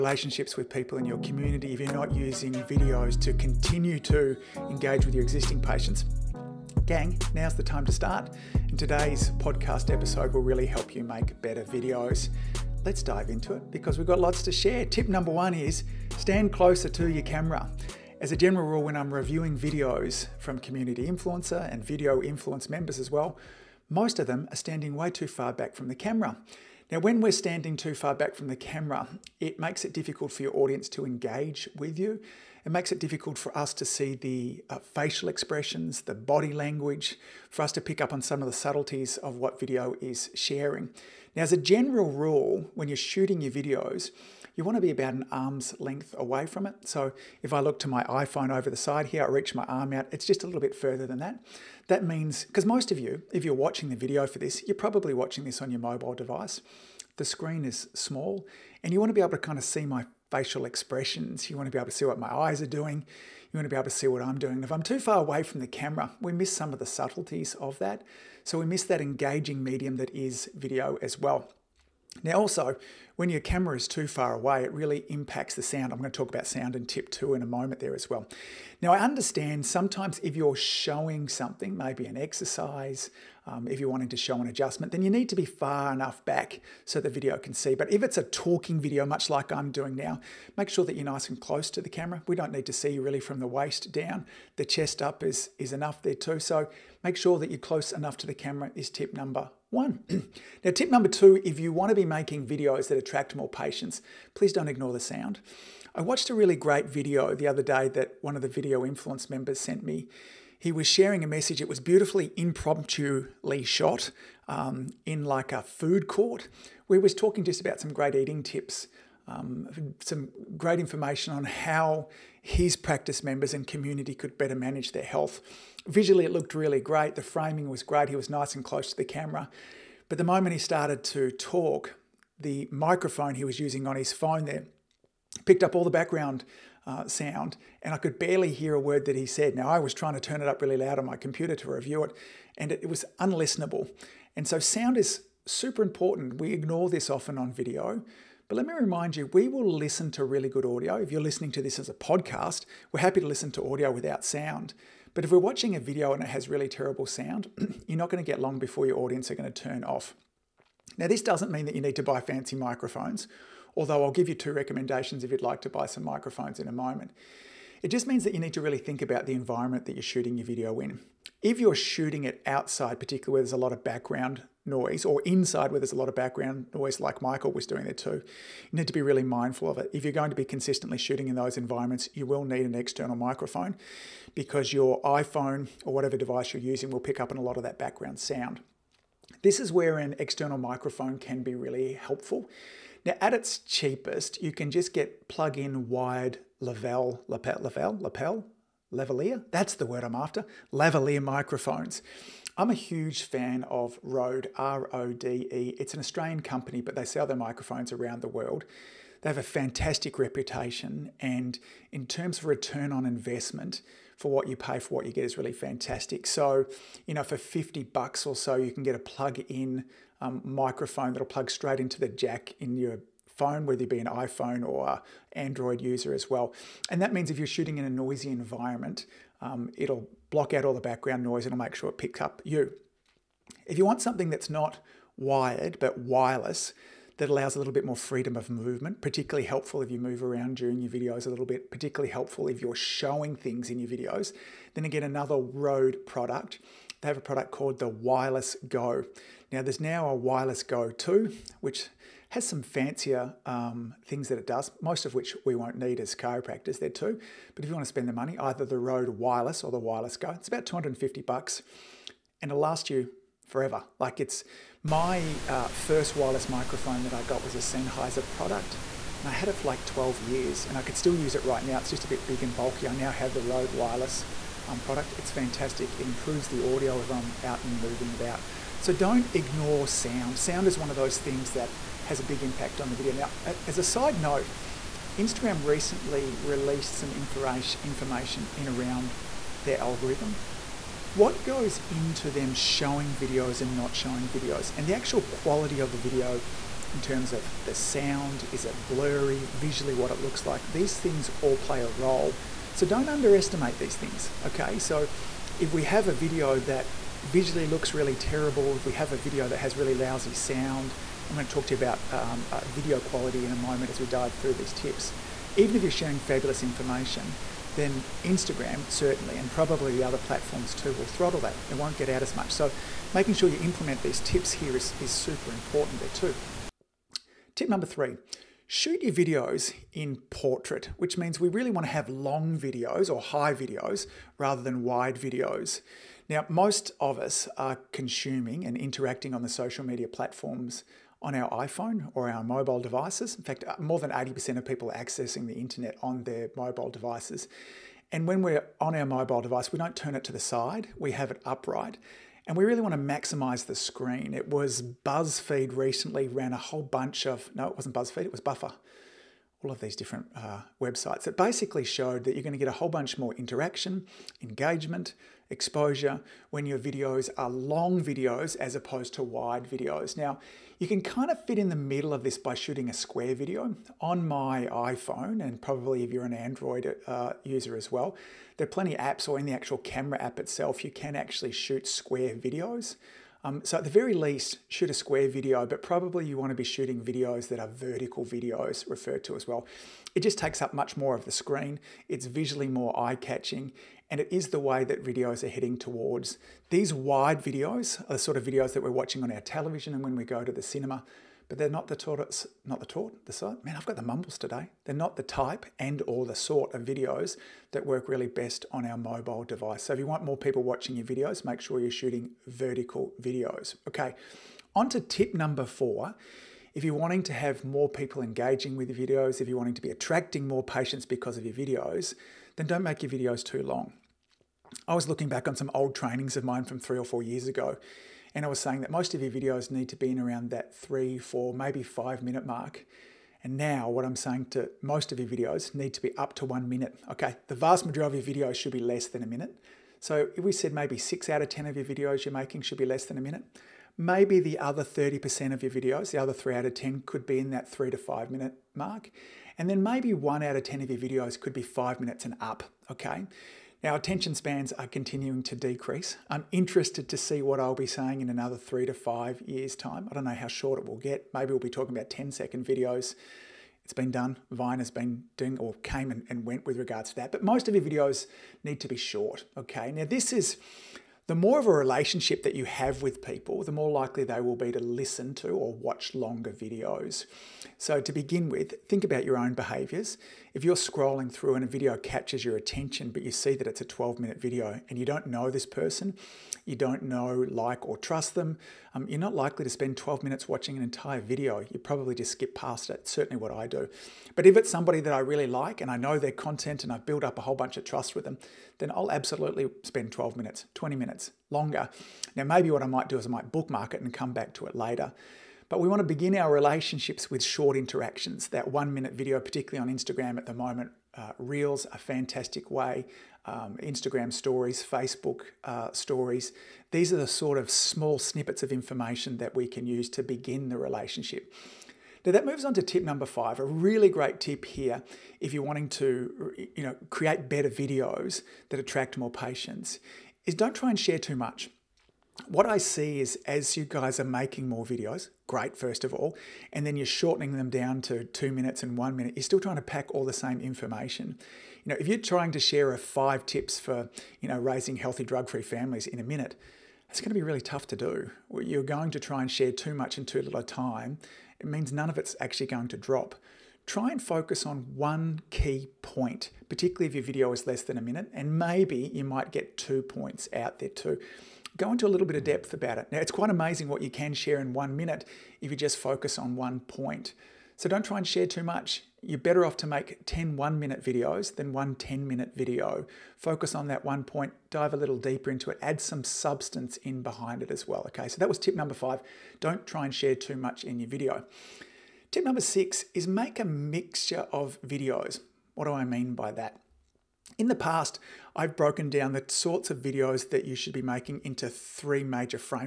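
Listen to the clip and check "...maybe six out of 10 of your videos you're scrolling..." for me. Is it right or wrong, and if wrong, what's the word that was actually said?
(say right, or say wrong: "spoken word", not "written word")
wrong: "making", not "scrolling".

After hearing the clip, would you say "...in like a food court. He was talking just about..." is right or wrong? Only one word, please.
right.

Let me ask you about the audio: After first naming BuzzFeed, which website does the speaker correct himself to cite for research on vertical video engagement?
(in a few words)
Buffer.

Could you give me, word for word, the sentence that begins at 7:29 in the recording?
And then maybe one out of 10 of your videos could be five minutes and up, okay?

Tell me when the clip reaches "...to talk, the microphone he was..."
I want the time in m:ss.
2:11.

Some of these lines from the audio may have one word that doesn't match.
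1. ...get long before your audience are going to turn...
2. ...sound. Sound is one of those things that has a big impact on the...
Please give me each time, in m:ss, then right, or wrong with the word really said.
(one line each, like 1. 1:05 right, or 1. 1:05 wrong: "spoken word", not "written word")
1. 2:38 right
2. 4:39 right.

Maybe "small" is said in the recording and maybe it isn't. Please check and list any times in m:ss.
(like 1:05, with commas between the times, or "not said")
0:57, 8:37.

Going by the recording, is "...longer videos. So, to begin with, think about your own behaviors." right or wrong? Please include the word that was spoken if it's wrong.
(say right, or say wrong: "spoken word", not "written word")
right.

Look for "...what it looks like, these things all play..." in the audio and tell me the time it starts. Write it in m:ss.
4:59.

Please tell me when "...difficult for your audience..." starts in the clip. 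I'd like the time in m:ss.
0:29.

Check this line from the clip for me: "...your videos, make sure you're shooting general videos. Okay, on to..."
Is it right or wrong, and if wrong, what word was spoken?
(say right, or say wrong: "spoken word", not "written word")
wrong: "vertical", not "general".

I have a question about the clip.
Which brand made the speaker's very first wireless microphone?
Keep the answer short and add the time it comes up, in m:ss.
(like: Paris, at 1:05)
Sennheiser, at 4:27.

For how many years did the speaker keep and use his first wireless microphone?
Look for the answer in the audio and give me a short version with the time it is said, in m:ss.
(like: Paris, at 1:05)
12 years, at 4:29.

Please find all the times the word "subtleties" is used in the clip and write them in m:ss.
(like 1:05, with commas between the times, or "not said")
0:38, 1:06.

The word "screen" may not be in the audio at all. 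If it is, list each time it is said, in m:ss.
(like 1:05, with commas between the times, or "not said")
0:57, 5:53, 6:31.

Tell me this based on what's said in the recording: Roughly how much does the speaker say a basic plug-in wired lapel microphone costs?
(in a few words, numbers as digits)
50 bucks.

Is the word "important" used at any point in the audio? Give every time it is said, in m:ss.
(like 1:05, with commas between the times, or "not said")
2:25, 5:25.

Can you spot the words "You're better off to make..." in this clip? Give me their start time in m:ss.
9:29.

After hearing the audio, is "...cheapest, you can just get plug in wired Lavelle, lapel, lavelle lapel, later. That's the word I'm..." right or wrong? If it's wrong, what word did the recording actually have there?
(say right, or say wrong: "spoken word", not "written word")
wrong: "lavalier", not "later".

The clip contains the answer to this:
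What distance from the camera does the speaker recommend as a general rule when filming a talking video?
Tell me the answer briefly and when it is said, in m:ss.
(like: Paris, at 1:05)
An arm's length, at 0:45.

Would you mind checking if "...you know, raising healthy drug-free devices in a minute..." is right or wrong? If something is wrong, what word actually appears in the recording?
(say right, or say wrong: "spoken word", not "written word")
wrong: "families", not "devices".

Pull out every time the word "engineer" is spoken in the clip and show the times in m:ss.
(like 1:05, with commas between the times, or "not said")
not said.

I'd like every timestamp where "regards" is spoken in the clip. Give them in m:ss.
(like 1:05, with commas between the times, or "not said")
7:46.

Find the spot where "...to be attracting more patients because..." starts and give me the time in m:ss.
6:59.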